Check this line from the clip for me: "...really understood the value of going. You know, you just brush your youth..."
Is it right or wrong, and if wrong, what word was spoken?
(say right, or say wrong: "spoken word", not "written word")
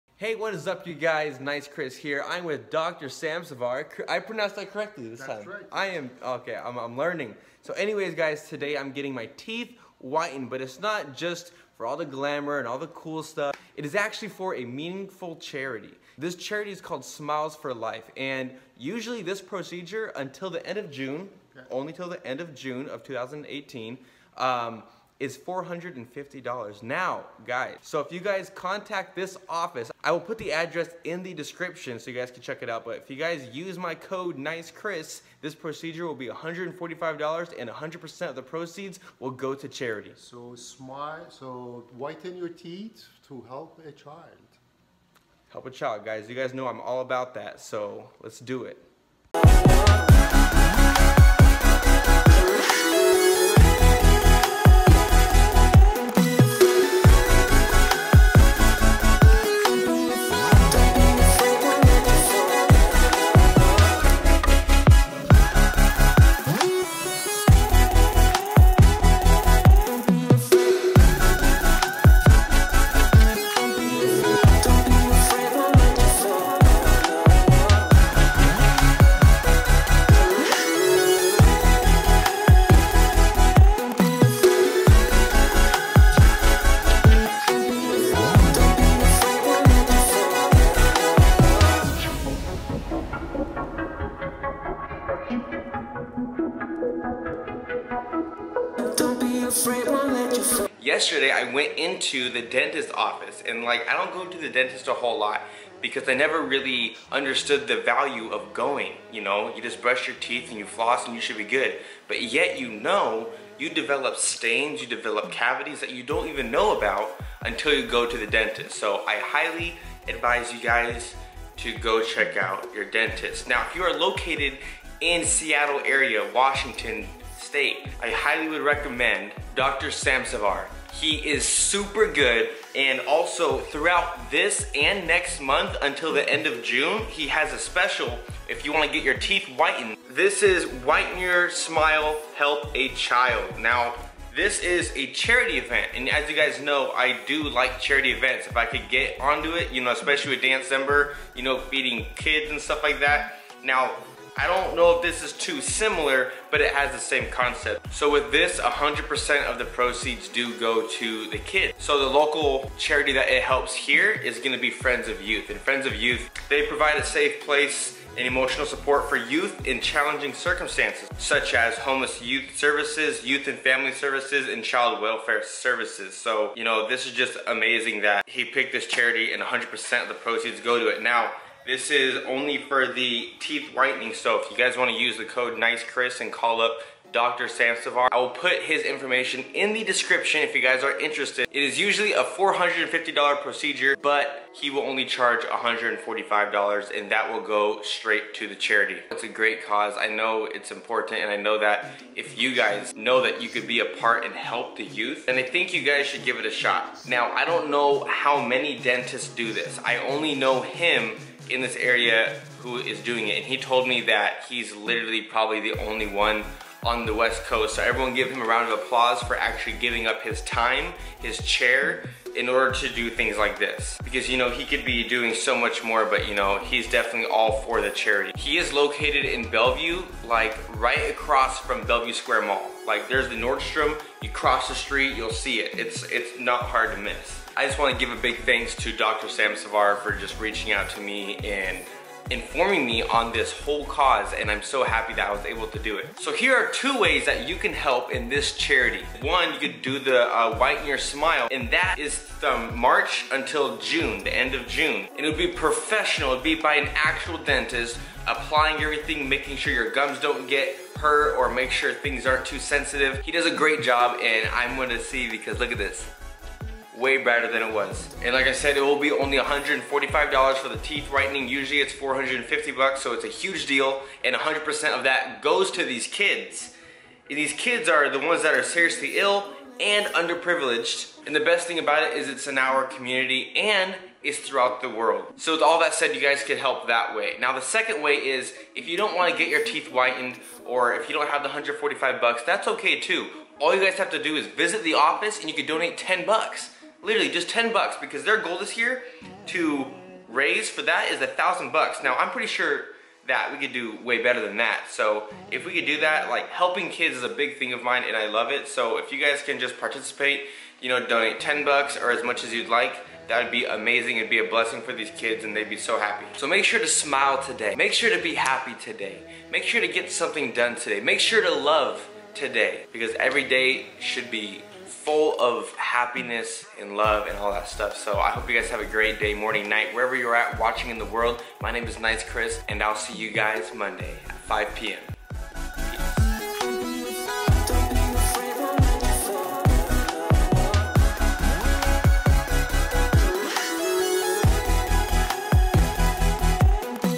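wrong: "teeth", not "youth".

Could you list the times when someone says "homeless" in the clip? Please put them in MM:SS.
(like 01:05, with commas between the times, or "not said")
02:51.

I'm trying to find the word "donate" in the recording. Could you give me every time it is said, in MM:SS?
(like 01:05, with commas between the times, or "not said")
04:55, 05:11.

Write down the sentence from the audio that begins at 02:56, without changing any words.
So, you know, this is just amazing that he picked this charity and 100% of the proceeds go to it.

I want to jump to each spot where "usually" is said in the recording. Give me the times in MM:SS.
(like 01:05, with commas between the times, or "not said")
00:18, 03:11, 04:31.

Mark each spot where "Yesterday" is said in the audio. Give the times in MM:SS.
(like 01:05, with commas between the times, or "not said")
01:40.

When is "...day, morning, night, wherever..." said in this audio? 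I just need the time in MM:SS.
05:29.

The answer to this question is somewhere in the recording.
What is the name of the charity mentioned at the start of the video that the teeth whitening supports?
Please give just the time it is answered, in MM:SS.
00:17.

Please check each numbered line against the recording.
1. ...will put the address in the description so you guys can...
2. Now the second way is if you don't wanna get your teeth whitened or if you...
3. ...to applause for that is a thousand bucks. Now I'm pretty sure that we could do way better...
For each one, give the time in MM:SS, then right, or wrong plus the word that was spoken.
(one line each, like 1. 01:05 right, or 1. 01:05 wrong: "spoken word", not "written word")
1. 00:30 right
2. 04:47 right
3. 04:59 wrong: "raise", not "applause".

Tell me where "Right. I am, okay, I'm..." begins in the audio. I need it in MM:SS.
00:05.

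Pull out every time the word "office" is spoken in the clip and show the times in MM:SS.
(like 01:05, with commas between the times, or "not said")
00:29, 01:42, 04:54.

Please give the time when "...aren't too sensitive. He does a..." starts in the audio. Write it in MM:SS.
04:22.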